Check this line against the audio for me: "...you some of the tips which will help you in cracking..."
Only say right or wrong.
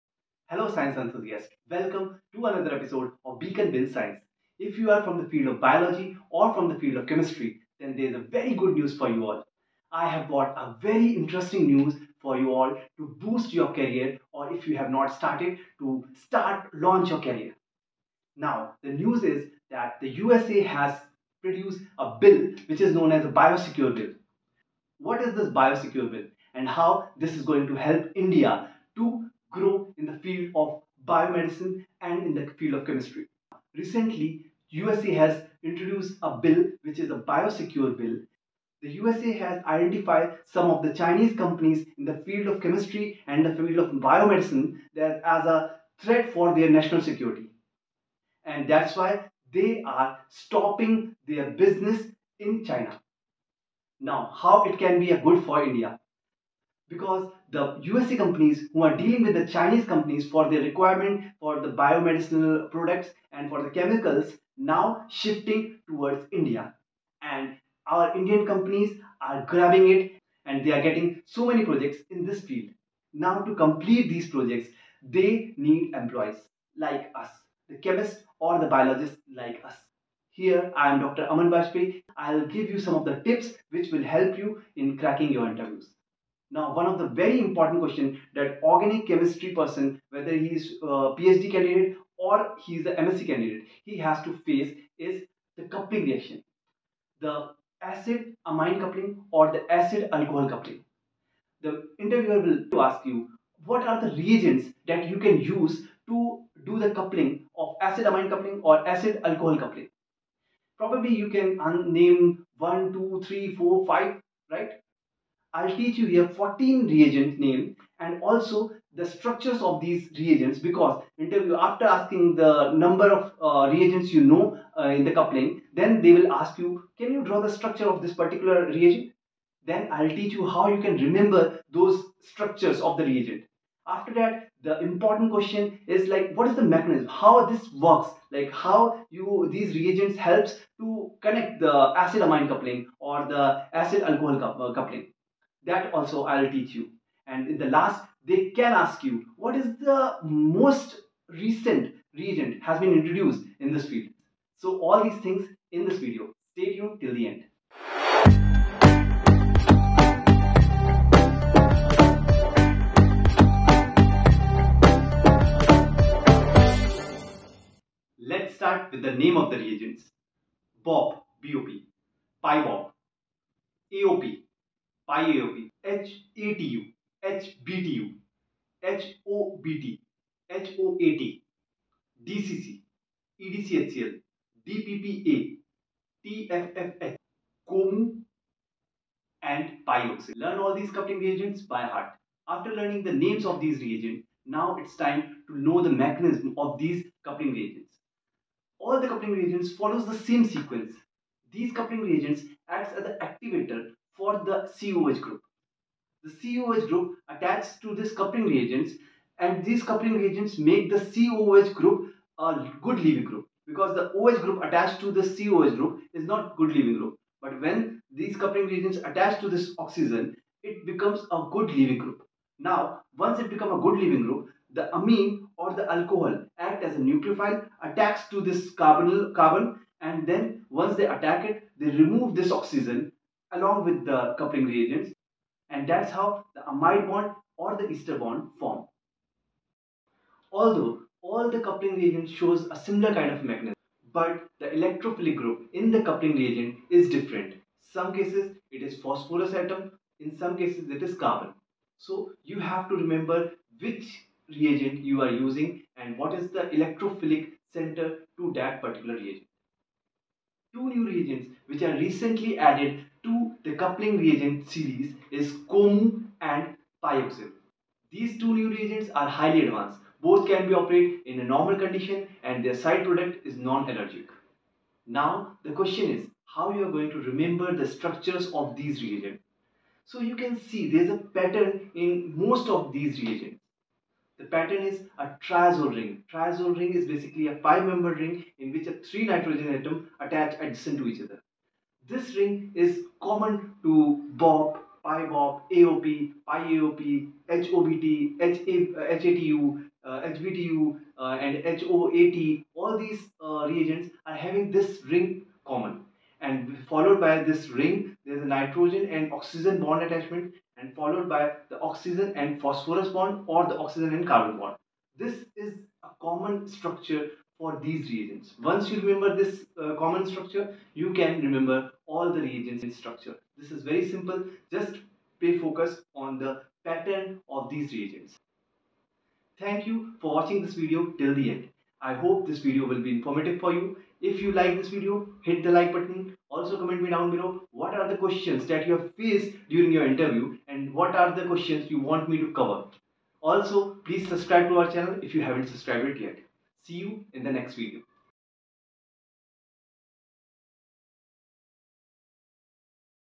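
right.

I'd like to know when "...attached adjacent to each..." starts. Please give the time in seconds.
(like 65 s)
290 s.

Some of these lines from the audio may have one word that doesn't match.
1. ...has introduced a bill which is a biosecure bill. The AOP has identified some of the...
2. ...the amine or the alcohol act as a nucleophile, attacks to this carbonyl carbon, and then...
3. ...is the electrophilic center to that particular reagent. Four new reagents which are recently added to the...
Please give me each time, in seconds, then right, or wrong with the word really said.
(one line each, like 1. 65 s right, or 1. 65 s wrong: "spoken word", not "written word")
1. 35 s wrong: "USA", not "AOP"
2. 224 s right
3. 256 s wrong: "Two", not "Four".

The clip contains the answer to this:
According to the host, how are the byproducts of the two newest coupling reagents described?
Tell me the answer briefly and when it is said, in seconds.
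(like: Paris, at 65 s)
Non-allergic, at 273 s.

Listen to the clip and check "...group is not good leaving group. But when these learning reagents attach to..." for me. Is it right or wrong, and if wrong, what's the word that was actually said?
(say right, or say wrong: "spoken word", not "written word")
wrong: "coupling", not "learning".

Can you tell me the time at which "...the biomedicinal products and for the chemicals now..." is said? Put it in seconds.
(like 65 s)
61 s.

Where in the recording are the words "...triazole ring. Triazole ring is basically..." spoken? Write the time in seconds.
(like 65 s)
285 s.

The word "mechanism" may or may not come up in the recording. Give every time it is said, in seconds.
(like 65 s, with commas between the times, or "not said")
136 s, 195 s, 243 s.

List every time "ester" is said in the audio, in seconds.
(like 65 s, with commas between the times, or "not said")
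237 s.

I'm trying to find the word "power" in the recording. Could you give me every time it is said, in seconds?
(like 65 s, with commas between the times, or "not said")
not said.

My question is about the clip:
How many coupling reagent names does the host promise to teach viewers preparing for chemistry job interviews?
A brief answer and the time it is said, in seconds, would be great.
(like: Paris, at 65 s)
14, at 116 s.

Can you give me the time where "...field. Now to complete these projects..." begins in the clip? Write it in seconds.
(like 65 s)
72 s.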